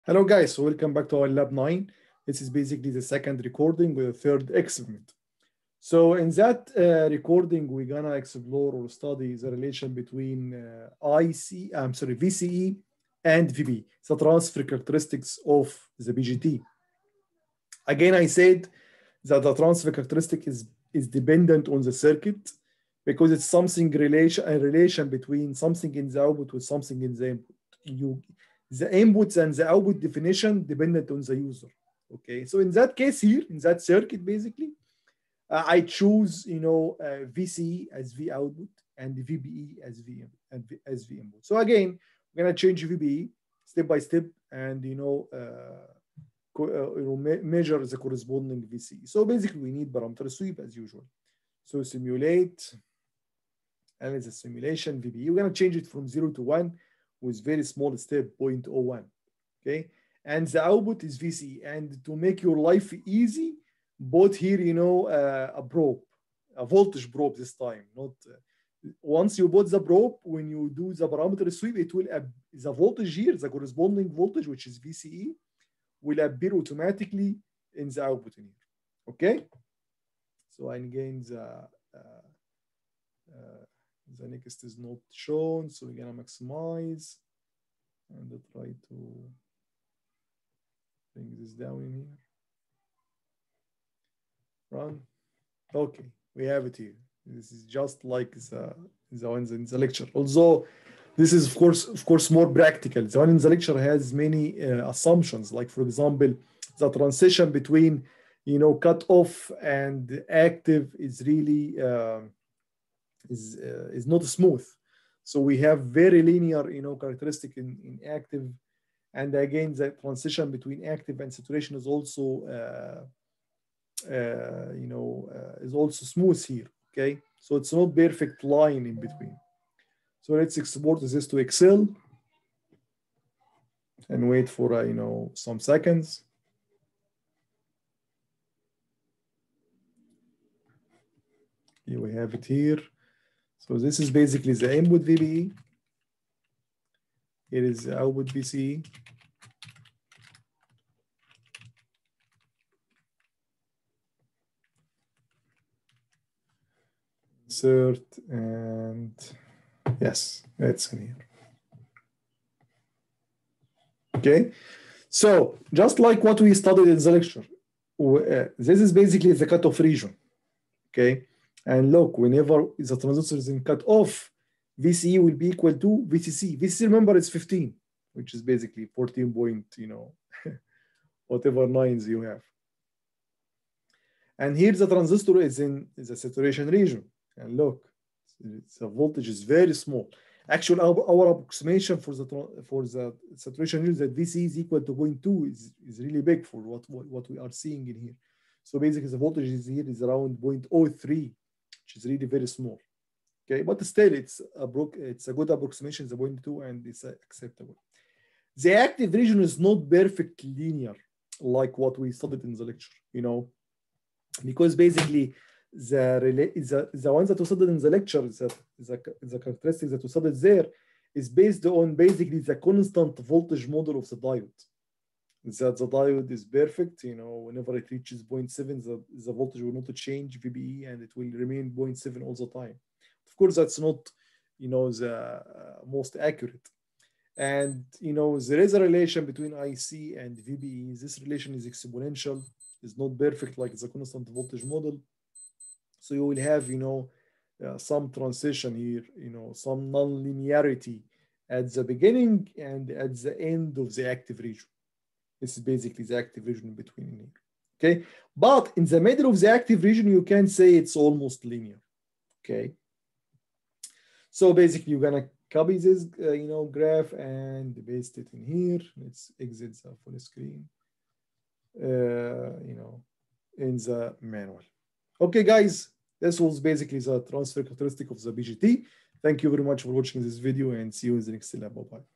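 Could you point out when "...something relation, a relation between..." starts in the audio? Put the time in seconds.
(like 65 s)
23 s.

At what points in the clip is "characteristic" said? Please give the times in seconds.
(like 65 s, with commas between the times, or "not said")
14 s, 19 s, 116 s, 219 s, 277 s.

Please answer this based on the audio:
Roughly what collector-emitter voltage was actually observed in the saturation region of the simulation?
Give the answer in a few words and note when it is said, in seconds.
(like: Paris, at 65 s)
0.03, at 200 s.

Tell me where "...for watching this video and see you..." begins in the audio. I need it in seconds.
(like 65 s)
279 s.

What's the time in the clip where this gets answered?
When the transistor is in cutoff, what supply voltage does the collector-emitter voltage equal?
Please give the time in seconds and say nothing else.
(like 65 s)
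177 s.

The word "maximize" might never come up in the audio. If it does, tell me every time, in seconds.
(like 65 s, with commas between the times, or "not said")
86 s.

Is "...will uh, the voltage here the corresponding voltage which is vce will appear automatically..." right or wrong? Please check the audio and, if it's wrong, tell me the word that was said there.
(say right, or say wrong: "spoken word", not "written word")
right.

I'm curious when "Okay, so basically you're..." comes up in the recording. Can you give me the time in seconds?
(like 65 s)
262 s.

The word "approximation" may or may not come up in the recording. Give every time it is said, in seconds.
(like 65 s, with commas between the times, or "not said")
191 s, 205 s.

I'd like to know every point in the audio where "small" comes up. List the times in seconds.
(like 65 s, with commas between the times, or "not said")
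57 s, 189 s, 202 s.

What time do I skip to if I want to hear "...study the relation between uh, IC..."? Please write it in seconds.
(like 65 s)
8 s.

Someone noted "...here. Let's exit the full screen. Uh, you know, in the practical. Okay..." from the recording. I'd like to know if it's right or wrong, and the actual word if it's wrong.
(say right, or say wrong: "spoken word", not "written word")
wrong: "manual", not "practical".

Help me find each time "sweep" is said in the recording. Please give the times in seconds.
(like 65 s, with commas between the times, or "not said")
50 s, 71 s.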